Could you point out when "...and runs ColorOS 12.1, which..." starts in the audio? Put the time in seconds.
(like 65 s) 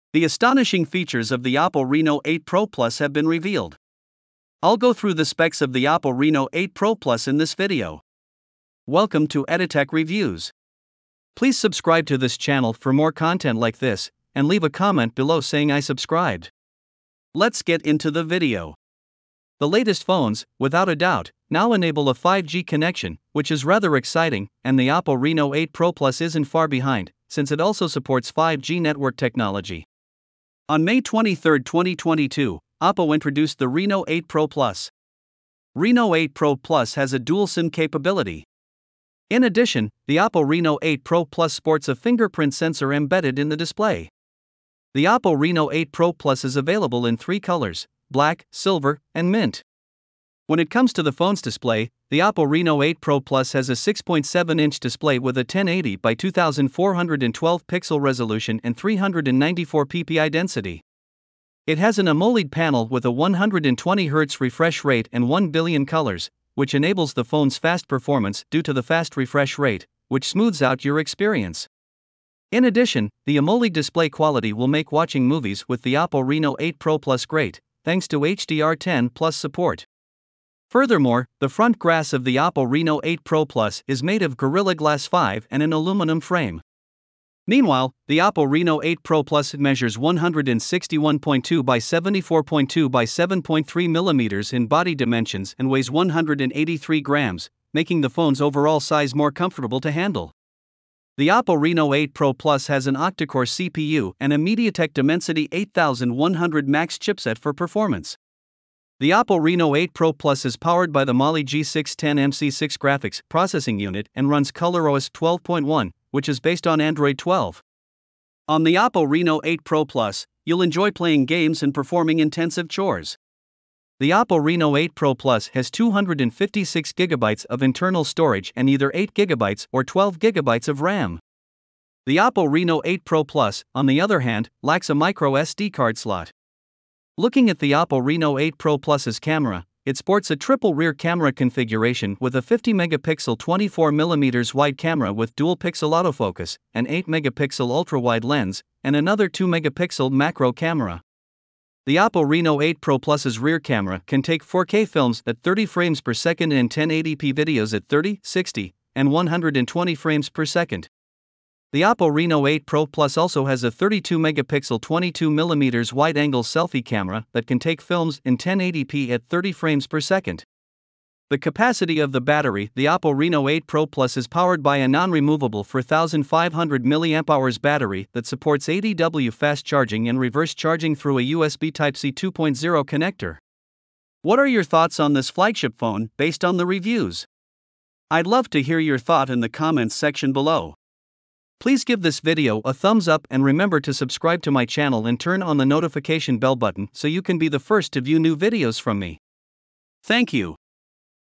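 114 s.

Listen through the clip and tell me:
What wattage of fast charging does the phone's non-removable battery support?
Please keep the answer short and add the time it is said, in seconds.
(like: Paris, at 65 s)
80W, at 178 s.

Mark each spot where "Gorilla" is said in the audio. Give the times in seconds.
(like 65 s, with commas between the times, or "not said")
84 s.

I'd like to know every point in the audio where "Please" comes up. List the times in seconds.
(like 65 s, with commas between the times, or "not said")
11 s, 191 s.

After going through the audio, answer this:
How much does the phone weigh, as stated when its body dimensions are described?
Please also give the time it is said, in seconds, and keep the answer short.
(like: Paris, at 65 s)
183 grams, at 95 s.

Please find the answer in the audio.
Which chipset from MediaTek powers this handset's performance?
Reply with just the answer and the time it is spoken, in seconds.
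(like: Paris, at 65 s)
Dimensity 8100 Max, at 104 s.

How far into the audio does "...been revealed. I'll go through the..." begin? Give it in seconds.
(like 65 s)
3 s.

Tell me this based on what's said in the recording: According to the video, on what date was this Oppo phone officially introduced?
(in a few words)
May 23, 2022.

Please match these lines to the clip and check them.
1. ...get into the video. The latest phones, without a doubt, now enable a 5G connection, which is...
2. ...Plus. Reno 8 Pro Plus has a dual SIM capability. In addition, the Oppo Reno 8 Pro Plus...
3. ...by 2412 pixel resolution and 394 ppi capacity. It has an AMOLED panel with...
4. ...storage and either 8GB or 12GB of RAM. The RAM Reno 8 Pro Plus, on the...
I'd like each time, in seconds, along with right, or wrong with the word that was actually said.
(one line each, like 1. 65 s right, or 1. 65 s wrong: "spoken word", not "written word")
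1. 17 s right
2. 34 s right
3. 55 s wrong: "density", not "capacity"
4. 128 s wrong: "Oppo", not "RAM".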